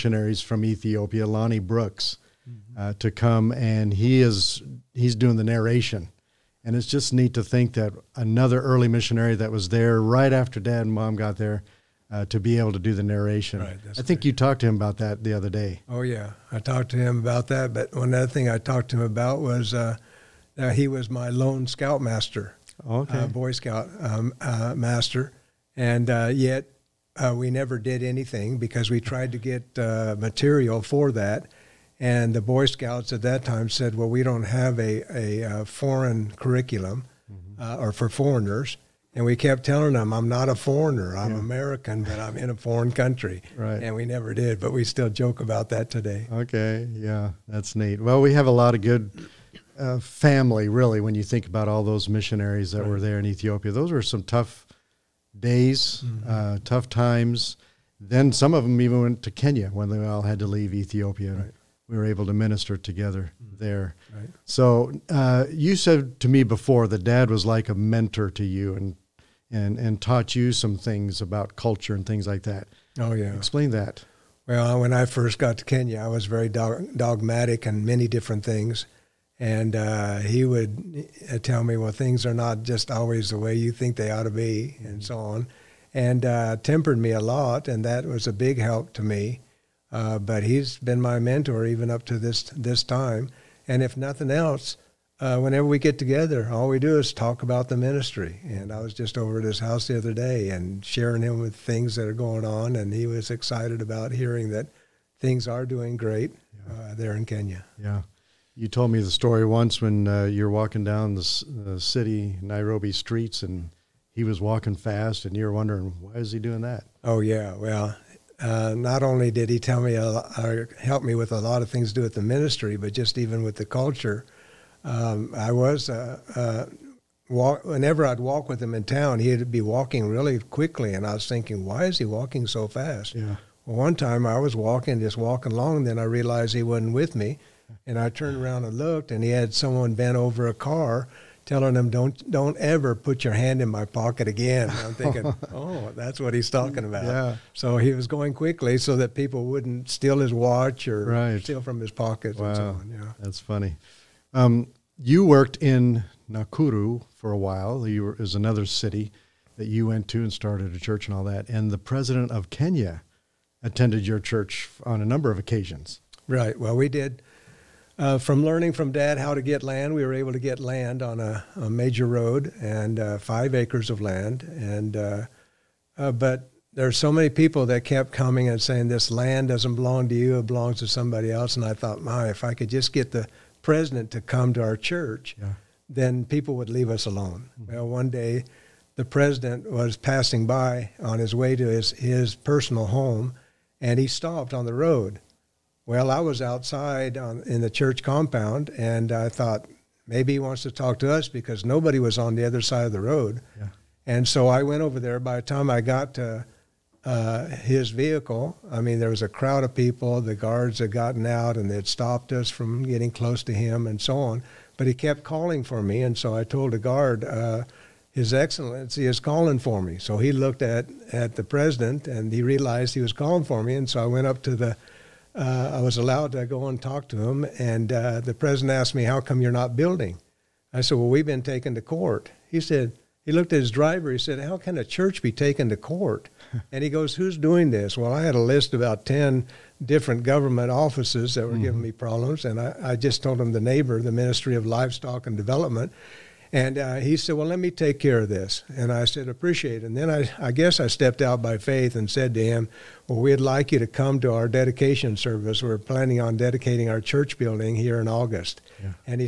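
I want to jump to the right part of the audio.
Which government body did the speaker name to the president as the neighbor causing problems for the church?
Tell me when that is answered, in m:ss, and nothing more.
4:04.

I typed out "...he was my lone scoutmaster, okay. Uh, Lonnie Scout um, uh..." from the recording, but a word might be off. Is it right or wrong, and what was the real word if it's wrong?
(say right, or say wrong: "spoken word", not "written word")
wrong: "Boy", not "Lonnie".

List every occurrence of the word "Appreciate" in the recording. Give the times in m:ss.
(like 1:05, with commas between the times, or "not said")
4:09.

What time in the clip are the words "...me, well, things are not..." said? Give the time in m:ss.
1:21.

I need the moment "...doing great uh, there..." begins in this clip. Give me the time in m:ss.
1:45.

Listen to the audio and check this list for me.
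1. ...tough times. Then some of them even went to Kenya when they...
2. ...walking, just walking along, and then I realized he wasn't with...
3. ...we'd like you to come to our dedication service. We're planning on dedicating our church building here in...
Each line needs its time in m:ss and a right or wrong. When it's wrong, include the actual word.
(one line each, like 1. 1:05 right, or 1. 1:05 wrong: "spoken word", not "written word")
1. 0:56 right
2. 2:14 right
3. 4:13 right.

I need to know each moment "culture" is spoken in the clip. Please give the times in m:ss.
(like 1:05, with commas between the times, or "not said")
1:11, 2:03.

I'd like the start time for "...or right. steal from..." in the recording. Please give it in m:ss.
2:30.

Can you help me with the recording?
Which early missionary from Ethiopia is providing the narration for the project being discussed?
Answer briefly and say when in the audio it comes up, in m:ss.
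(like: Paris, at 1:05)
Lonnie Brooks, at 0:01.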